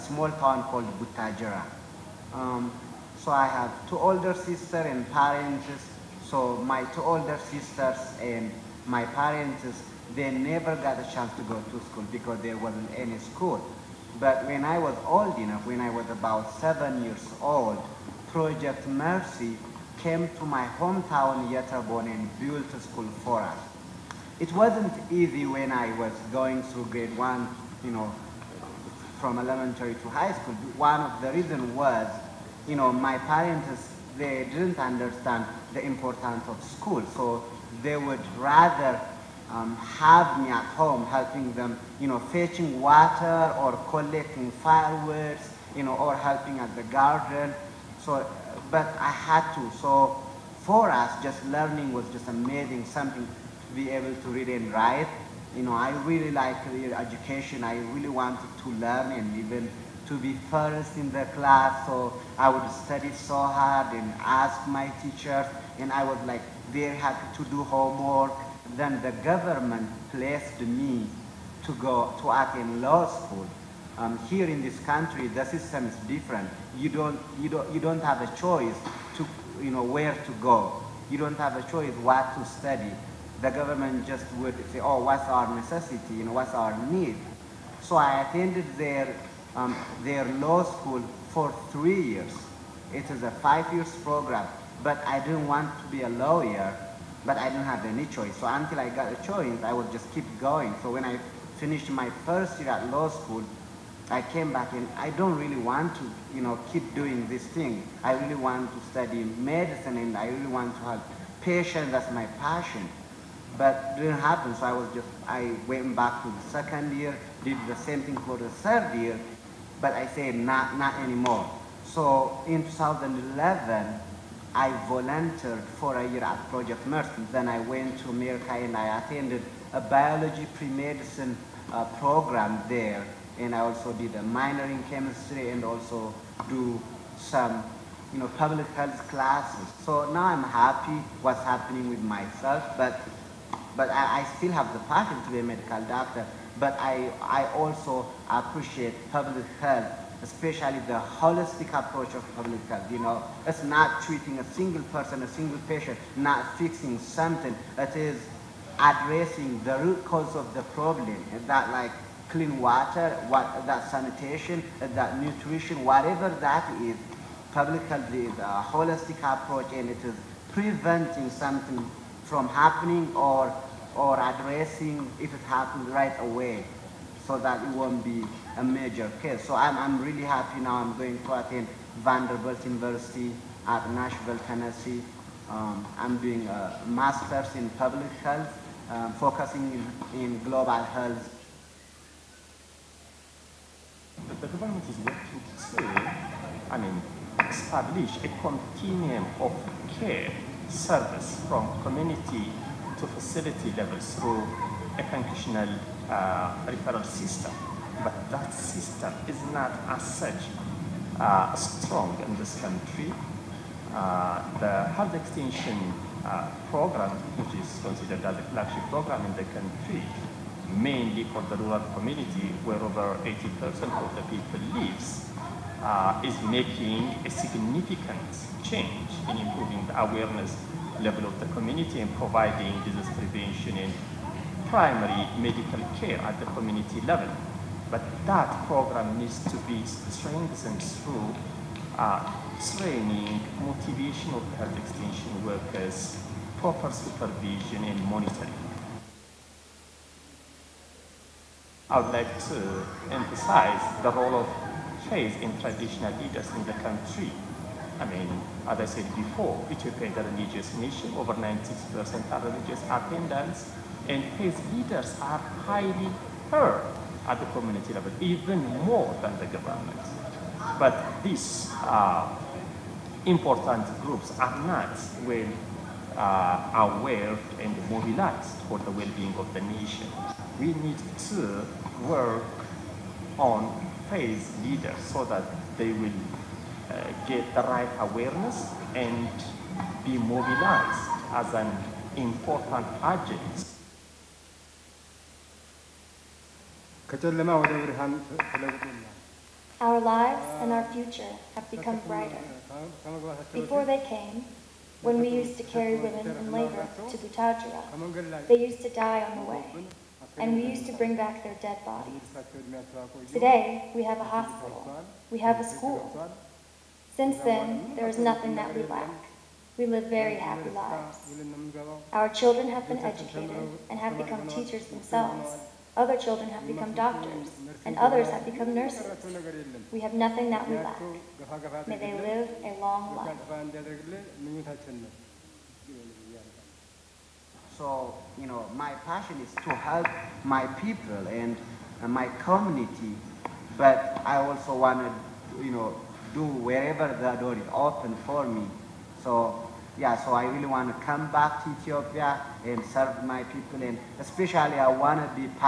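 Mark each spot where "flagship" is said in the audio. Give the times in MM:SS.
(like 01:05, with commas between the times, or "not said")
03:38.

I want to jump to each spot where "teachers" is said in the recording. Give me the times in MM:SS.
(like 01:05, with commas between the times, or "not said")
01:05, 05:24.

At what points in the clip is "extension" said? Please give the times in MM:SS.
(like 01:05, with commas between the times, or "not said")
03:35, 04:04.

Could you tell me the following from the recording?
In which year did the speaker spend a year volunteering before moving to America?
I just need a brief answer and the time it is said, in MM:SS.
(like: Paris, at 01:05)
2011, at 02:02.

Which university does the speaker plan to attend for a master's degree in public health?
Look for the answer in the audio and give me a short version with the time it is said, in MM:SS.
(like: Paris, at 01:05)
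Vanderbilt University, at 03:01.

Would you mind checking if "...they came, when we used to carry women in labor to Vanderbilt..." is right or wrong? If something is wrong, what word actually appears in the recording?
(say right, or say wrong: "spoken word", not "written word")
wrong: "Butajira", not "Vanderbilt".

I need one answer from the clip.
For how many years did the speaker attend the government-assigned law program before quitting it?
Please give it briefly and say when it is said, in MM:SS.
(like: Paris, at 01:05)
3, at 01:31.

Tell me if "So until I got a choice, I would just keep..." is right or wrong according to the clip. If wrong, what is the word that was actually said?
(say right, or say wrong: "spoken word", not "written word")
right.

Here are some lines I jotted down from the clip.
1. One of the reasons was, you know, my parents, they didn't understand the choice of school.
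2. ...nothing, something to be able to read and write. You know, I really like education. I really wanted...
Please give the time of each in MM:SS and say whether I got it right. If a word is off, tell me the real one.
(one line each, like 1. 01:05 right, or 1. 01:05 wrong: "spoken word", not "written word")
1. 00:30 wrong: "importance", not "choice"
2. 00:52 wrong: "amazing", not "nothing".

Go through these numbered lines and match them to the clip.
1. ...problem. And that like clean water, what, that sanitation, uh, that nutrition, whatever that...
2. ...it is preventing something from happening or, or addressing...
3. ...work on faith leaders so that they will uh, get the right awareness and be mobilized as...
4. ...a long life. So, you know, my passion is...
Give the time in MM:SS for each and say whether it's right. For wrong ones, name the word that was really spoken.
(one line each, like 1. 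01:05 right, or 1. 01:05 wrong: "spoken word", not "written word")
1. 02:40 right
2. 02:49 right
3. 04:42 right
4. 05:32 right.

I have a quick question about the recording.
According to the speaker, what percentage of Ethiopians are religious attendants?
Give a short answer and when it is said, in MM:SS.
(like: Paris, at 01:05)
Over 96%, at 04:21.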